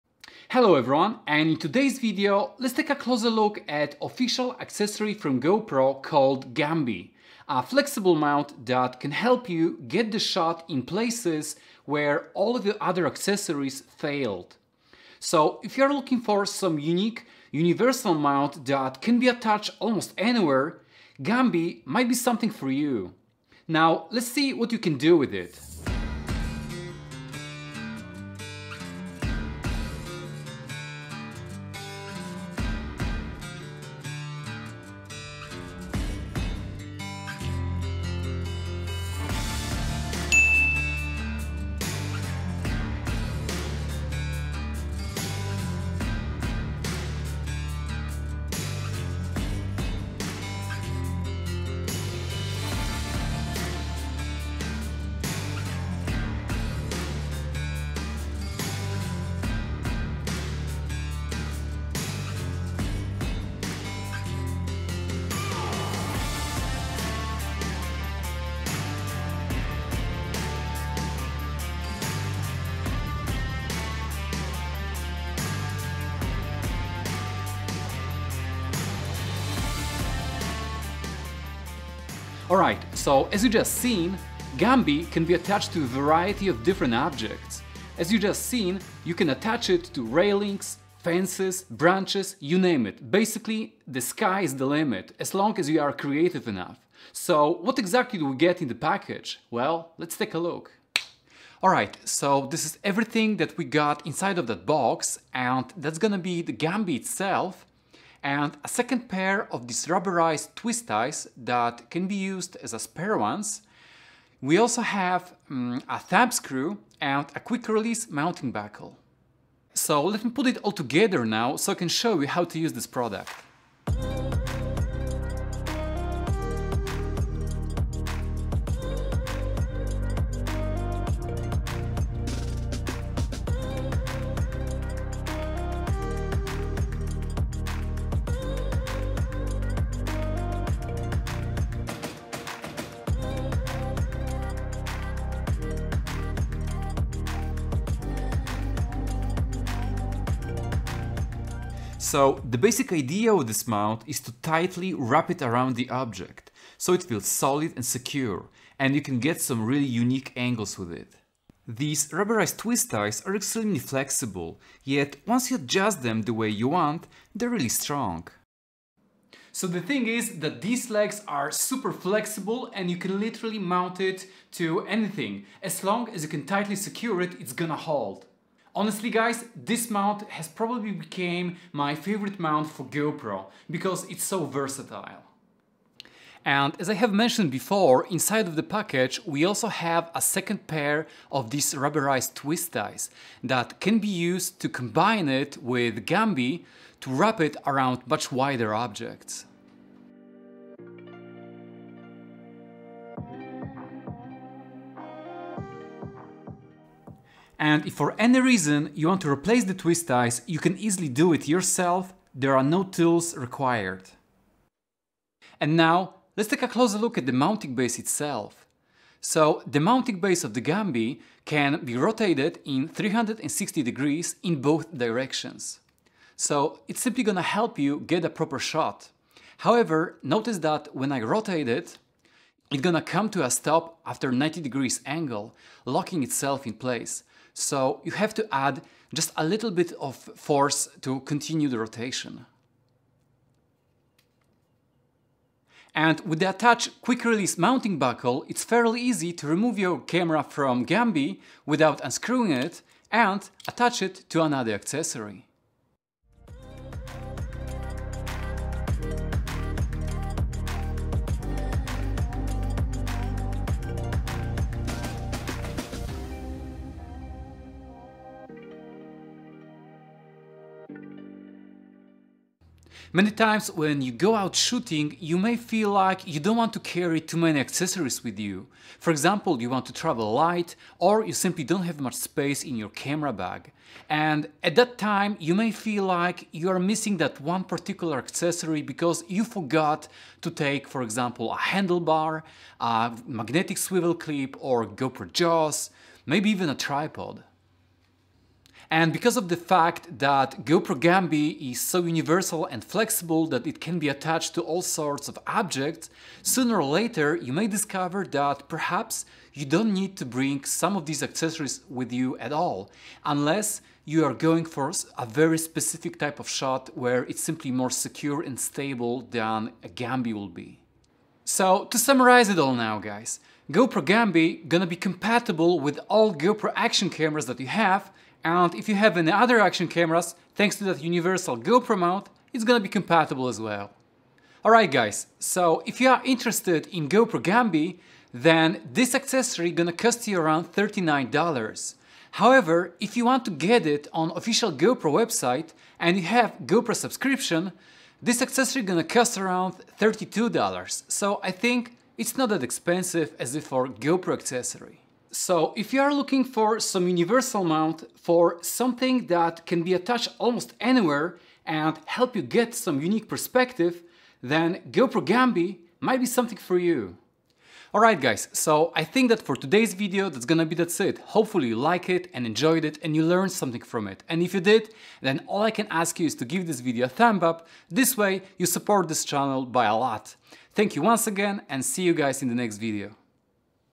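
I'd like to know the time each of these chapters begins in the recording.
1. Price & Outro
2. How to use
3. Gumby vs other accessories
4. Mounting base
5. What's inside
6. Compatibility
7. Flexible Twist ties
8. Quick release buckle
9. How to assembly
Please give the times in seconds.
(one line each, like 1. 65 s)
1. 335 s
2. 25 s
3. 276 s
4. 216 s
5. 97 s
6. 321 s
7. 151 s
8. 246 s
9. 124 s.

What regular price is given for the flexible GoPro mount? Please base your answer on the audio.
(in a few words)
$39.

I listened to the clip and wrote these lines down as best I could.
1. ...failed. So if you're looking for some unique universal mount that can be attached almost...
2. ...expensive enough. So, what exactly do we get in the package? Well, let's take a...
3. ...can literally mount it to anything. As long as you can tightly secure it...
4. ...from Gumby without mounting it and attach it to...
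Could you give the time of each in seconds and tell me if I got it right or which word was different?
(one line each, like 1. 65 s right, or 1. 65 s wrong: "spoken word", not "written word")
1. 13 s right
2. 95 s wrong: "creative", not "expensive"
3. 172 s right
4. 250 s wrong: "unscrewing", not "mounting".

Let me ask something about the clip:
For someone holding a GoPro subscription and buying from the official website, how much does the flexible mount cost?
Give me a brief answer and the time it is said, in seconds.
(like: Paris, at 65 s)
$32, at 349 s.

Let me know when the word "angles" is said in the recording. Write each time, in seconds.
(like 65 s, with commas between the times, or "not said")
160 s, 235 s.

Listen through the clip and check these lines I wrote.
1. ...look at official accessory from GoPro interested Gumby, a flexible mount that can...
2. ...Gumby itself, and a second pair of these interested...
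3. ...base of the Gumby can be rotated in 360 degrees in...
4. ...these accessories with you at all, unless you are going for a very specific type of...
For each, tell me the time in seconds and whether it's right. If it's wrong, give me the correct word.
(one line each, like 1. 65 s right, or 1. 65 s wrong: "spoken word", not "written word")
1. 3 s wrong: "called", not "interested"
2. 106 s wrong: "rubberized", not "interested"
3. 220 s right
4. 311 s right.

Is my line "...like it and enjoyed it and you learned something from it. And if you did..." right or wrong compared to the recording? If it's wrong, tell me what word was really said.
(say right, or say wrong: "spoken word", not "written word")
right.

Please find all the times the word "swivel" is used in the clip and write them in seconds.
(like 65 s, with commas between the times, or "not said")
293 s.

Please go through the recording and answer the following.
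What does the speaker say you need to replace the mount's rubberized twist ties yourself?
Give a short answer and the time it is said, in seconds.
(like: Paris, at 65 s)
No tools, at 212 s.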